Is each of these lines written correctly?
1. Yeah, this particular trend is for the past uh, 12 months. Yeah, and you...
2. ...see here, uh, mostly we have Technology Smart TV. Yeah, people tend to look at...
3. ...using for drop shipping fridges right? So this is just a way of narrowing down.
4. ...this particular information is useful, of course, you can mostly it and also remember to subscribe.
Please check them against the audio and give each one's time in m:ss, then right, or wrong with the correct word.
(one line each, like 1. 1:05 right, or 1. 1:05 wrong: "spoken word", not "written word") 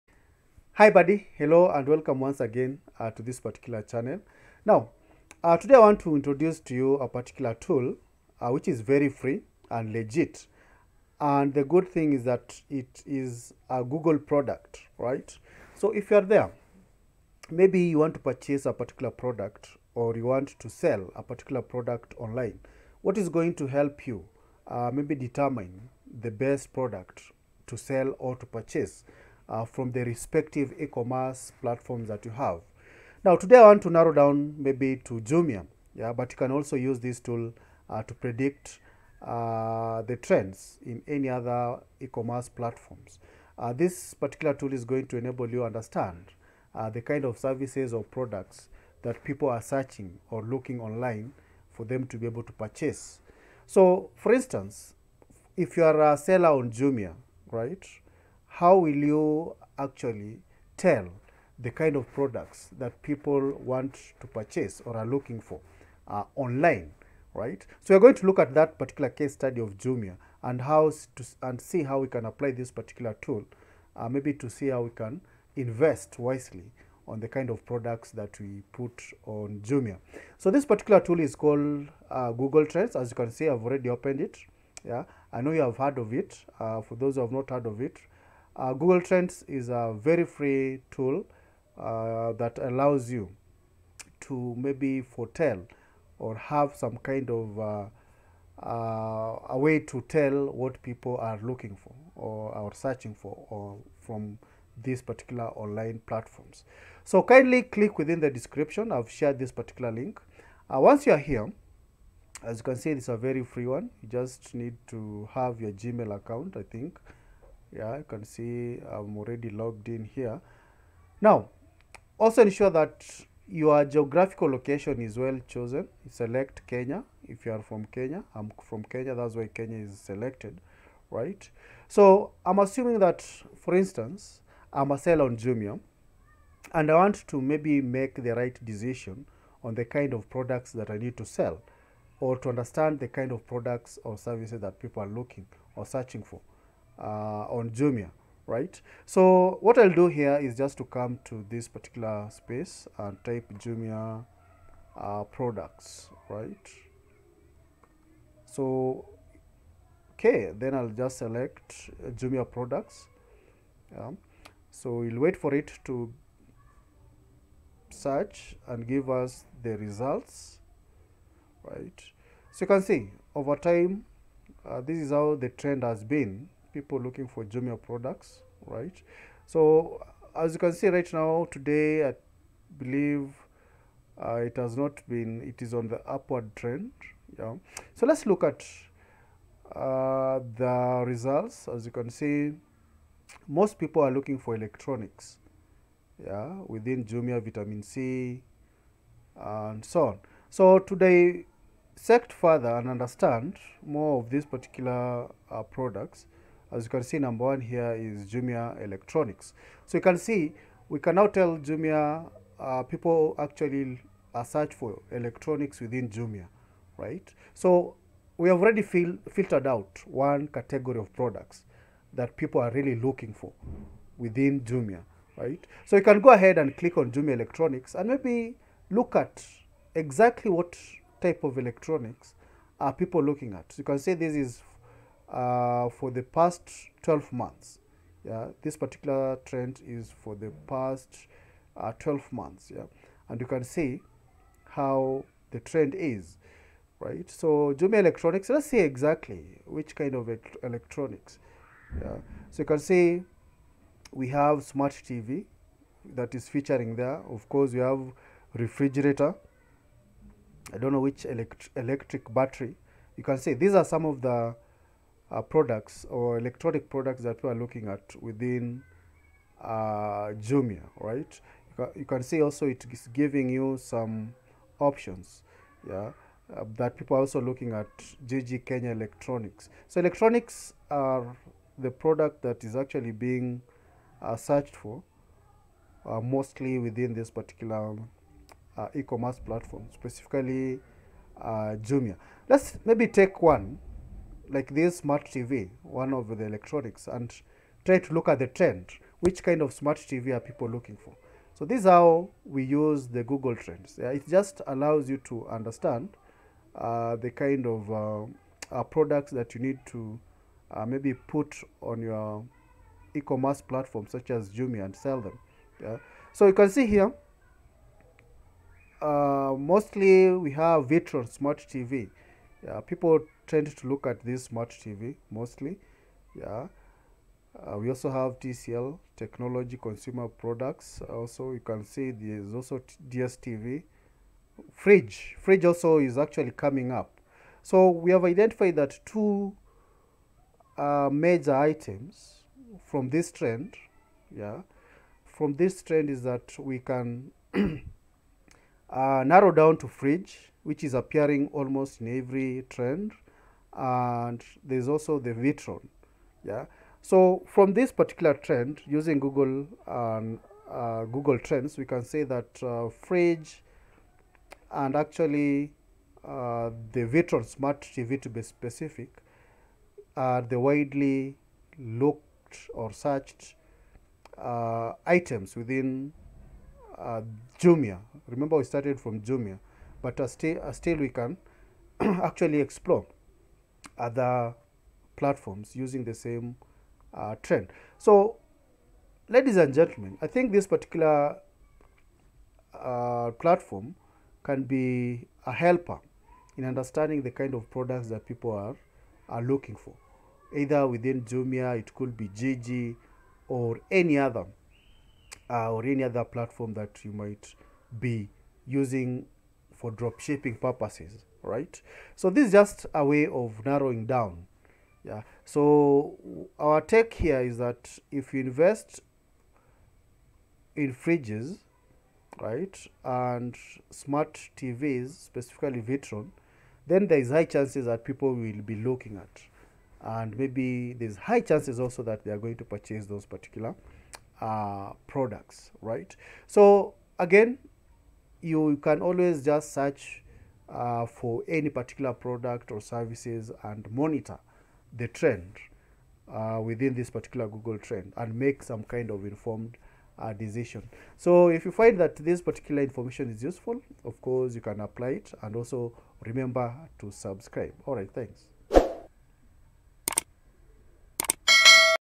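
1. 3:58 right
2. 5:16 wrong: "Vitron", not "Technology"
3. 6:48 wrong: "purposes", not "fridges"
4. 7:32 wrong: "apply", not "mostly".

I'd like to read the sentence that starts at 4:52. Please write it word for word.
Let's maybe take one like this smart TV, one of the electronics, and try to look at the trend.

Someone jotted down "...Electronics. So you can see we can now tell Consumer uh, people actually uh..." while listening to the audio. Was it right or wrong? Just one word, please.
wrong.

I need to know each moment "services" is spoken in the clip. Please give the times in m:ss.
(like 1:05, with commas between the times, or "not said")
0:47, 2:24, 7:22.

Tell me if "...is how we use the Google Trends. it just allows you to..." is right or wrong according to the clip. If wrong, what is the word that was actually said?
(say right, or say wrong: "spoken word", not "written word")
right.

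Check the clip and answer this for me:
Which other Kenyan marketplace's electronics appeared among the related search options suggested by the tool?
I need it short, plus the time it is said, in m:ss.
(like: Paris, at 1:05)
Jiji Kenya, at 4:38.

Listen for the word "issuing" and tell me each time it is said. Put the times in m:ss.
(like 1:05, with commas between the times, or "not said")
not said.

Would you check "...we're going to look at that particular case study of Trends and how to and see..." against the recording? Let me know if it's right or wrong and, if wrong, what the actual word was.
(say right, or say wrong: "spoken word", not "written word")
wrong: "Jumia", not "Trends".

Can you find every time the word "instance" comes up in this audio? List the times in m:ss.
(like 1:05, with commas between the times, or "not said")
0:54, 2:13.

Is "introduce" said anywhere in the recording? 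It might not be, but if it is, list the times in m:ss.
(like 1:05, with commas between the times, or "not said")
0:06.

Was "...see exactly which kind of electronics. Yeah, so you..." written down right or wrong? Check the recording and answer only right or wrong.
right.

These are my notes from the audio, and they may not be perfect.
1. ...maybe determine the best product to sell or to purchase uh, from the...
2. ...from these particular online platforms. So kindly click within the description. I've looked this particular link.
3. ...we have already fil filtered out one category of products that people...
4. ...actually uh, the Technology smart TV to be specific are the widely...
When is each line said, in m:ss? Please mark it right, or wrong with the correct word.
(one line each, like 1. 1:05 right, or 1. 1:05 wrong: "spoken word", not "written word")
1. 0:24 right
2. 1:44 wrong: "shared", not "looked"
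3. 3:38 right
4. 6:04 wrong: "Vitron", not "Technology".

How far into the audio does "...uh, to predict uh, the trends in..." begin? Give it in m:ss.
0:37.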